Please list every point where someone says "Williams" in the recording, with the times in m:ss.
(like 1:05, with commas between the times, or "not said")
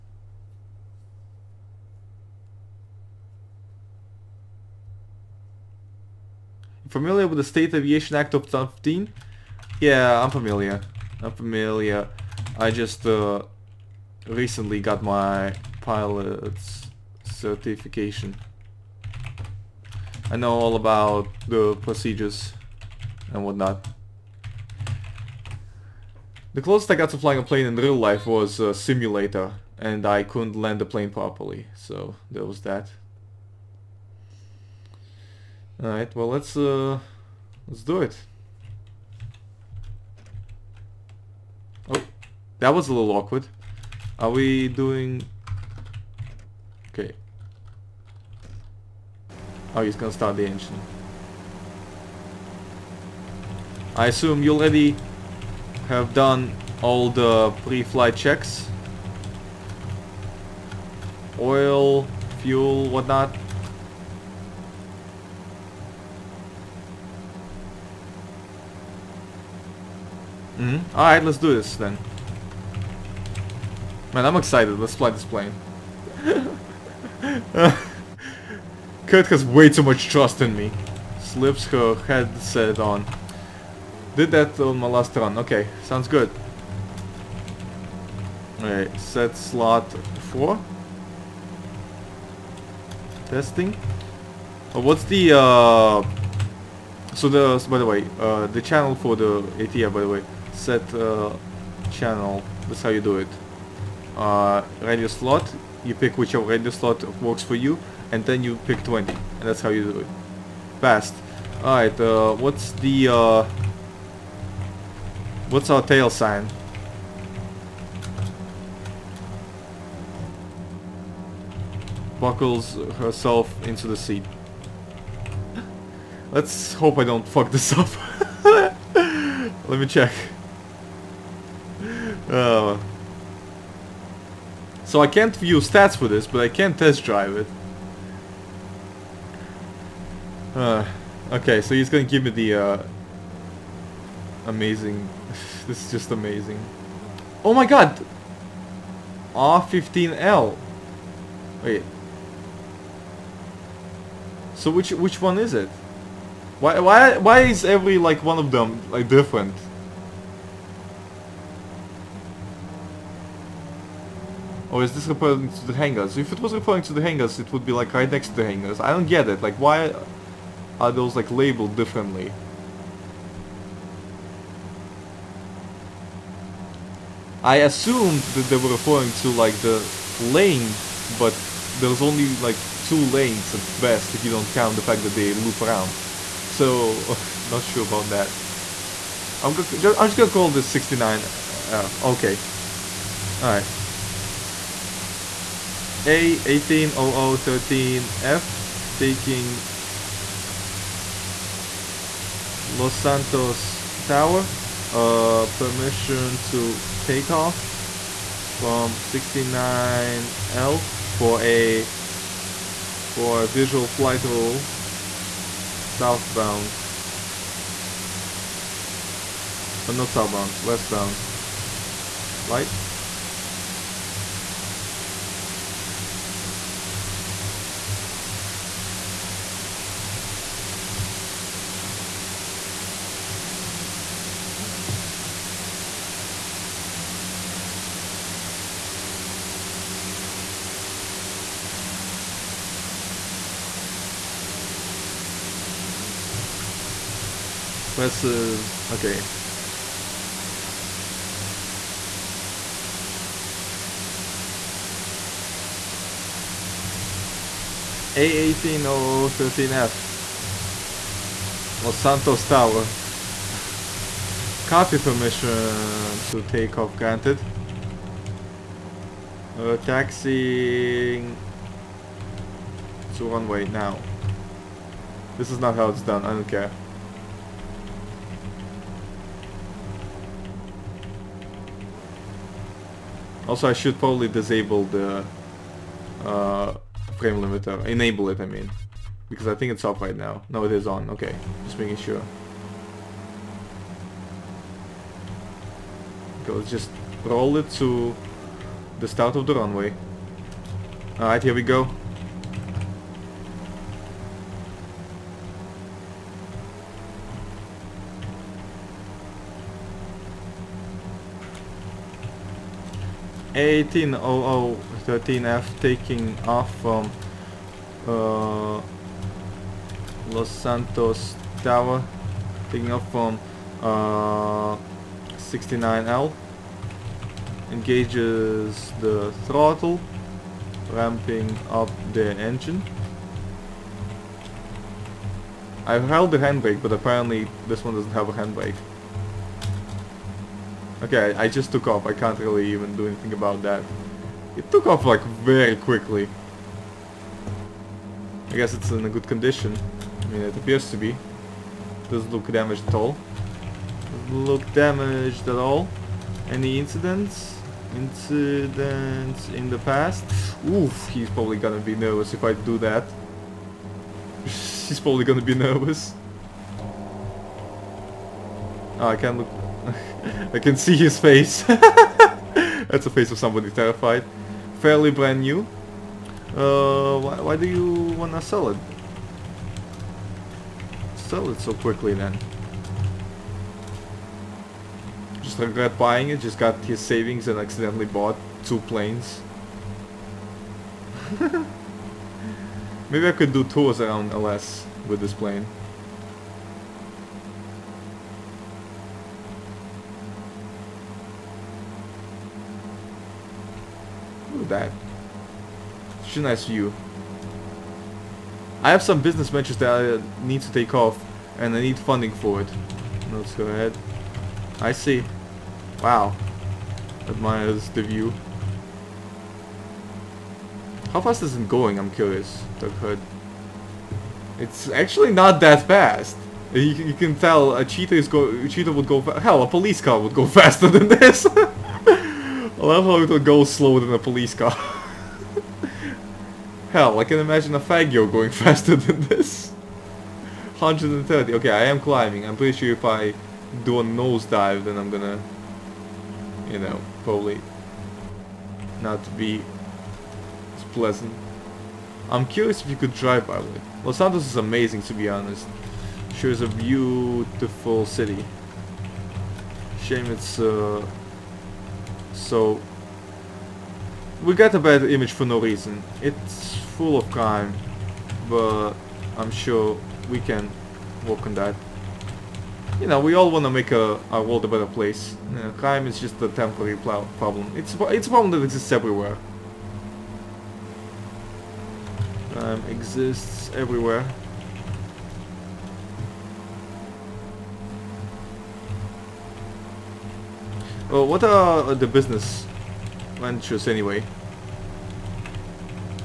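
not said.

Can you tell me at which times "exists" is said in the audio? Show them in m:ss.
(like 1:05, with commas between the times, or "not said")
7:58, 8:02.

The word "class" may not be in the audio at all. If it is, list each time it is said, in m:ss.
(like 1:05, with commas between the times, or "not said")
not said.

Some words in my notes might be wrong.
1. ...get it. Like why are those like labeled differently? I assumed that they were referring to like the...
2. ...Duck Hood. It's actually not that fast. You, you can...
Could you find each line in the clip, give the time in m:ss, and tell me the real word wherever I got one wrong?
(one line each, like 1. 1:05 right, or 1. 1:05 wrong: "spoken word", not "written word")
1. 2:49 right
2. 7:02 right.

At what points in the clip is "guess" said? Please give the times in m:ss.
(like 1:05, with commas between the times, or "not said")
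5:48.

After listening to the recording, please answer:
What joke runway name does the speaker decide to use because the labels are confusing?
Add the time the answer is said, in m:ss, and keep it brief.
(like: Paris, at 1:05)
69, at 3:10.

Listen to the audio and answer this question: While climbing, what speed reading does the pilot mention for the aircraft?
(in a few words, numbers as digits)
130.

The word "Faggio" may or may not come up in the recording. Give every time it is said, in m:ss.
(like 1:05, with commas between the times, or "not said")
7:17.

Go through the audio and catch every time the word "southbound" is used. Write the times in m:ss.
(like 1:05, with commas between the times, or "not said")
3:35, 3:40.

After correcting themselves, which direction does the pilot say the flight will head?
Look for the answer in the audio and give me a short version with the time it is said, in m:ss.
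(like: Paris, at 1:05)
westbound, at 3:40.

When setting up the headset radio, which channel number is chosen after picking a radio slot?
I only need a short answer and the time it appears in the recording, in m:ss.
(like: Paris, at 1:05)
20, at 1:48.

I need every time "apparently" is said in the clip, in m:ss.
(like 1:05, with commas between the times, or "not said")
5:36.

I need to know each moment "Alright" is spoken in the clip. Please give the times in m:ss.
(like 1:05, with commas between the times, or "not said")
0:35, 1:10, 1:28, 1:51, 3:13, 5:01.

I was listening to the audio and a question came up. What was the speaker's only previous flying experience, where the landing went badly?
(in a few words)
a simulator.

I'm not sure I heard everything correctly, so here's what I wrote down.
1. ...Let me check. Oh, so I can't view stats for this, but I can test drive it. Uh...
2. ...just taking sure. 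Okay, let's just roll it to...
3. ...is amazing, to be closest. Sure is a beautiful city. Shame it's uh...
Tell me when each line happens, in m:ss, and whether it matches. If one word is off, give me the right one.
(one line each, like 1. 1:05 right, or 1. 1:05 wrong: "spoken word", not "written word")
1. 2:08 right
2. 4:51 wrong: "making", not "taking"
3. 7:34 wrong: "honest", not "closest".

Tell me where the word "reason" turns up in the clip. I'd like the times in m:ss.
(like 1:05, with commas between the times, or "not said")
7:45.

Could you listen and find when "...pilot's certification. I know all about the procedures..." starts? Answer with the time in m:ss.
0:15.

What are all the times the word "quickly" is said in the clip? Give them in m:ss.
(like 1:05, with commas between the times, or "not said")
5:45, 6:21.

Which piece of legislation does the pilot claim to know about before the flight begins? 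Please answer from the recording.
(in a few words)
State Aviation Act of 2015.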